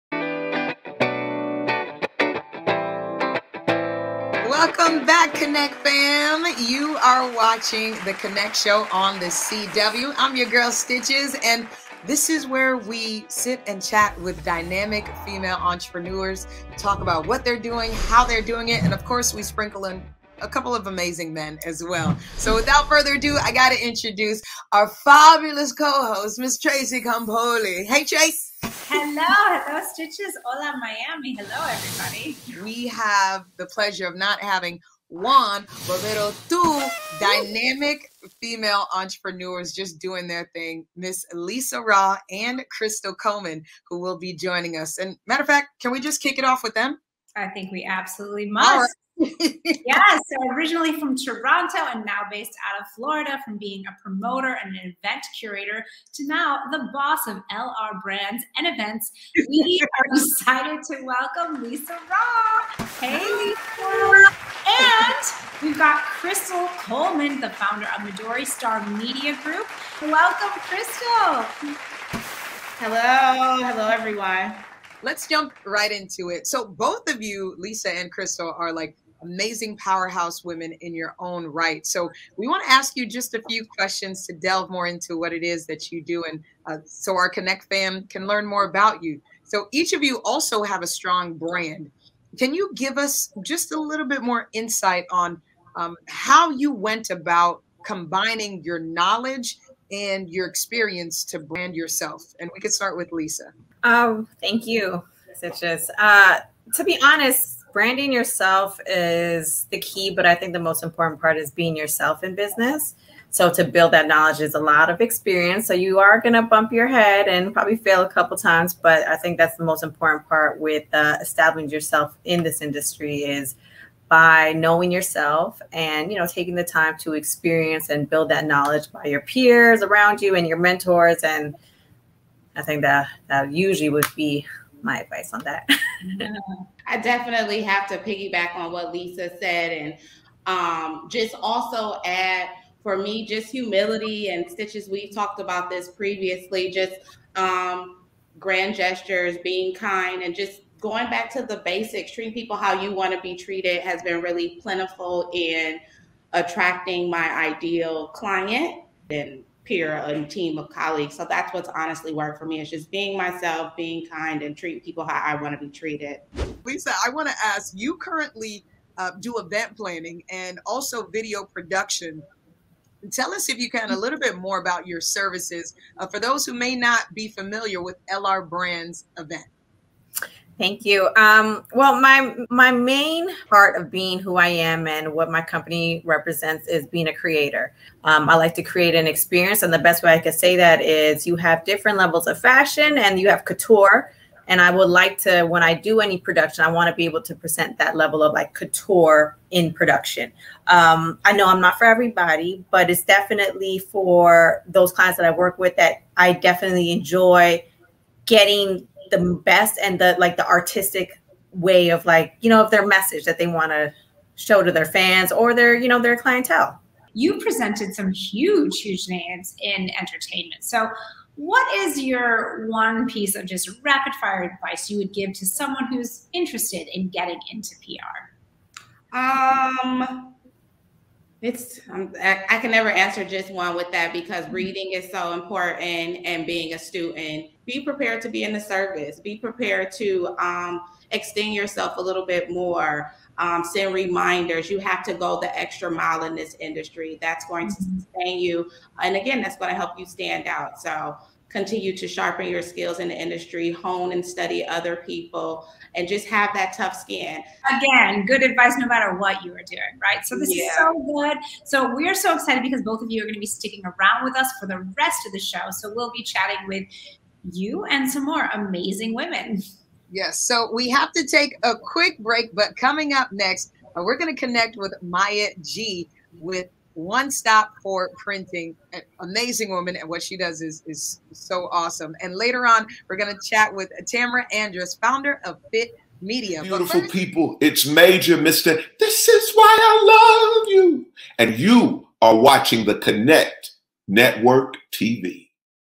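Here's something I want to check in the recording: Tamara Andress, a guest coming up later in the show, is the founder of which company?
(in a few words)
Fit Media.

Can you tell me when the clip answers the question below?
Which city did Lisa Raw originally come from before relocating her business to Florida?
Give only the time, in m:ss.
0:51.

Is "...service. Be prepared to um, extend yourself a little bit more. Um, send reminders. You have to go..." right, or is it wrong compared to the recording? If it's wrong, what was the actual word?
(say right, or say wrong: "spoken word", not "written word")
right.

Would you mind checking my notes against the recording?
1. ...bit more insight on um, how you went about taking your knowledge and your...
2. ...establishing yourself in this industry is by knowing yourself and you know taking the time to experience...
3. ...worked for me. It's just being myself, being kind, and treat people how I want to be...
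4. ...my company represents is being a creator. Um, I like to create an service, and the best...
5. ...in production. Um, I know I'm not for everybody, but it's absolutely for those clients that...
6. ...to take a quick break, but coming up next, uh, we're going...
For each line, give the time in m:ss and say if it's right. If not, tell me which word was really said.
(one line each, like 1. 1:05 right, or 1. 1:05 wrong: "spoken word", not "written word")
1. 1:34 wrong: "combining", not "taking"
2. 2:01 right
3. 2:42 right
4. 3:05 wrong: "experience", not "service"
5. 3:19 wrong: "definitely", not "absolutely"
6. 4:31 right.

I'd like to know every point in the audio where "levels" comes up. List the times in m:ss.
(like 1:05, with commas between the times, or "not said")
3:11, 3:17.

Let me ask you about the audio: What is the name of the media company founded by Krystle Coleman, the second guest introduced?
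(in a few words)
Midori Star Media Group.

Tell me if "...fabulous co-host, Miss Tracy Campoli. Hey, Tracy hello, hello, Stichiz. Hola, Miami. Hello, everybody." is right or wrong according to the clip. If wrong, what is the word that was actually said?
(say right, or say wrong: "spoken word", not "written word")
right.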